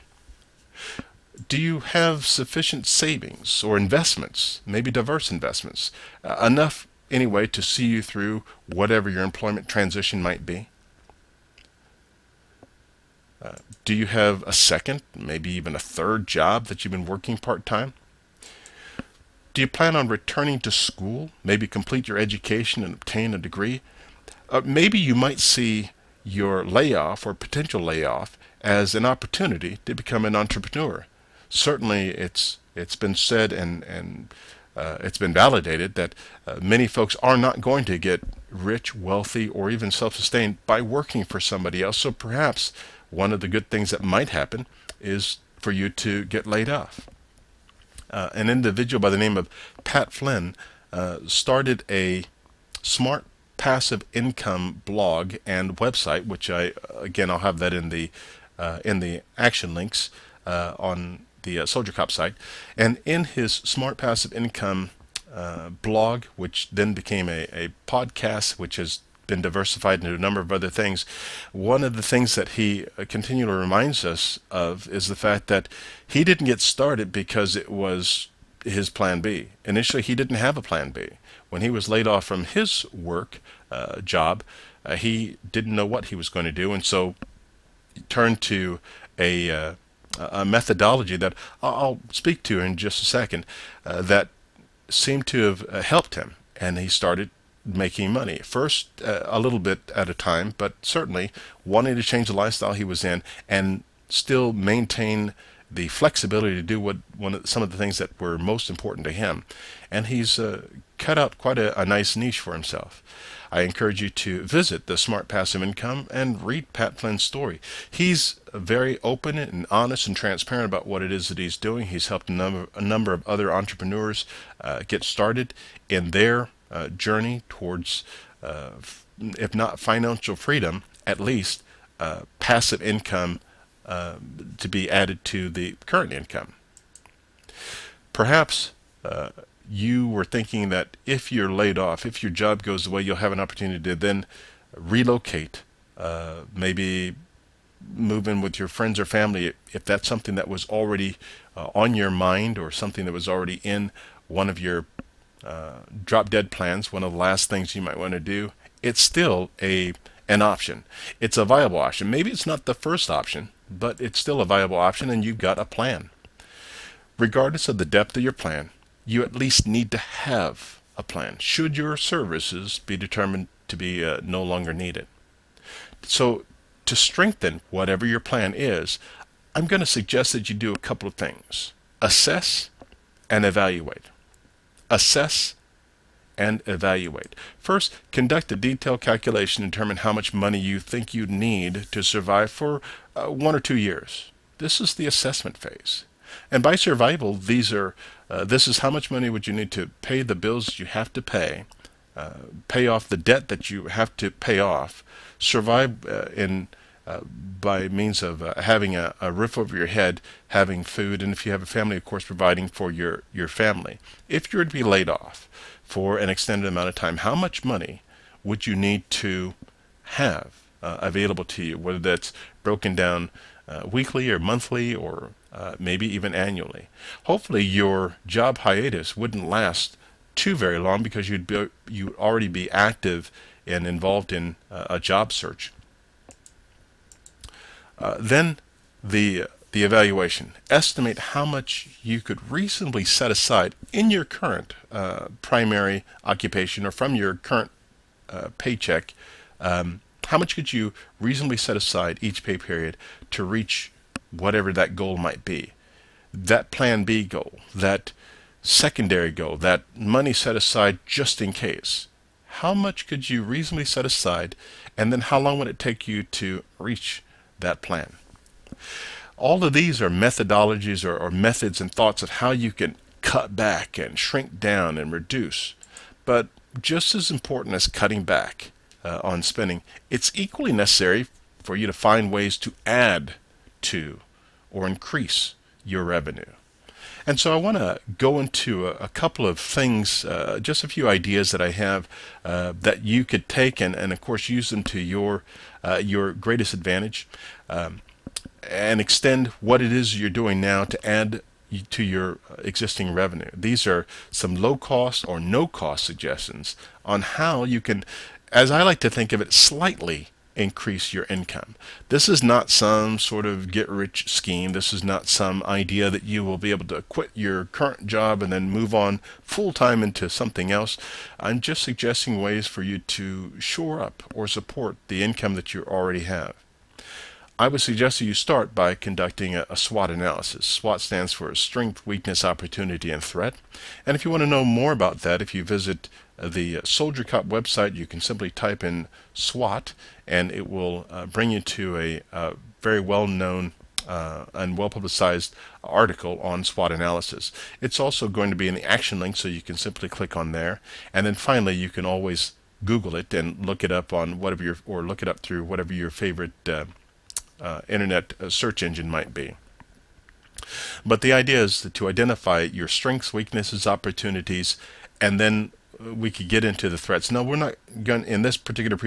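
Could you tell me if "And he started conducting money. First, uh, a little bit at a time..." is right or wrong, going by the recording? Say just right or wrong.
wrong.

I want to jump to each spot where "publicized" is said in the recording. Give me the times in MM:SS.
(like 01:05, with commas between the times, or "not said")
05:44.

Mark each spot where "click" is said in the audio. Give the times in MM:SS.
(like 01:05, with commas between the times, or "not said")
05:50.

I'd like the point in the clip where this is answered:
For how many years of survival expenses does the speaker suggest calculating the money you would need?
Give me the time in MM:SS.
03:13.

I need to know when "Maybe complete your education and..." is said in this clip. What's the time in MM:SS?
00:21.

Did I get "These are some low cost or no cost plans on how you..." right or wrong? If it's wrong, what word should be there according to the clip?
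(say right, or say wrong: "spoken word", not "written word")
wrong: "suggestions", not "plans".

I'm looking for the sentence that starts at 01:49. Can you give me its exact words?
And he's uh, cut out quite a, a, nice niche for himself.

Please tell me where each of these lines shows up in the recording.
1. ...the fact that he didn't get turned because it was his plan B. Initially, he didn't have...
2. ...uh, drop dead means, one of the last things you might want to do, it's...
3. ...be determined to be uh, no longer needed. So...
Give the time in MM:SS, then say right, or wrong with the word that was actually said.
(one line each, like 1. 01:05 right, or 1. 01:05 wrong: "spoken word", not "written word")
1. 01:15 wrong: "started", not "turned"
2. 02:35 wrong: "plans", not "means"
3. 02:52 right.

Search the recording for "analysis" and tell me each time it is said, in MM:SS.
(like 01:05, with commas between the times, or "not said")
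05:30, 05:46.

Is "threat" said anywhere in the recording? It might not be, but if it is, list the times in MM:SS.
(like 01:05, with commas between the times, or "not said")
05:33, 06:06.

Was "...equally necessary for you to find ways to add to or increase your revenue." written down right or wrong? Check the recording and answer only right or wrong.
right.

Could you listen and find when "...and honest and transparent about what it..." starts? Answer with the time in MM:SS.
01:59.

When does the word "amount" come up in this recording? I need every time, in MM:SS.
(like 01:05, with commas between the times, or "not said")
03:36.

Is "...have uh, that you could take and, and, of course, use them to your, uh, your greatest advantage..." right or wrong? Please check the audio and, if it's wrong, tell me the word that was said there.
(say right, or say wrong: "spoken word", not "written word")
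right.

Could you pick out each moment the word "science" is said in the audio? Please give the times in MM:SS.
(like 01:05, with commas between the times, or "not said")
not said.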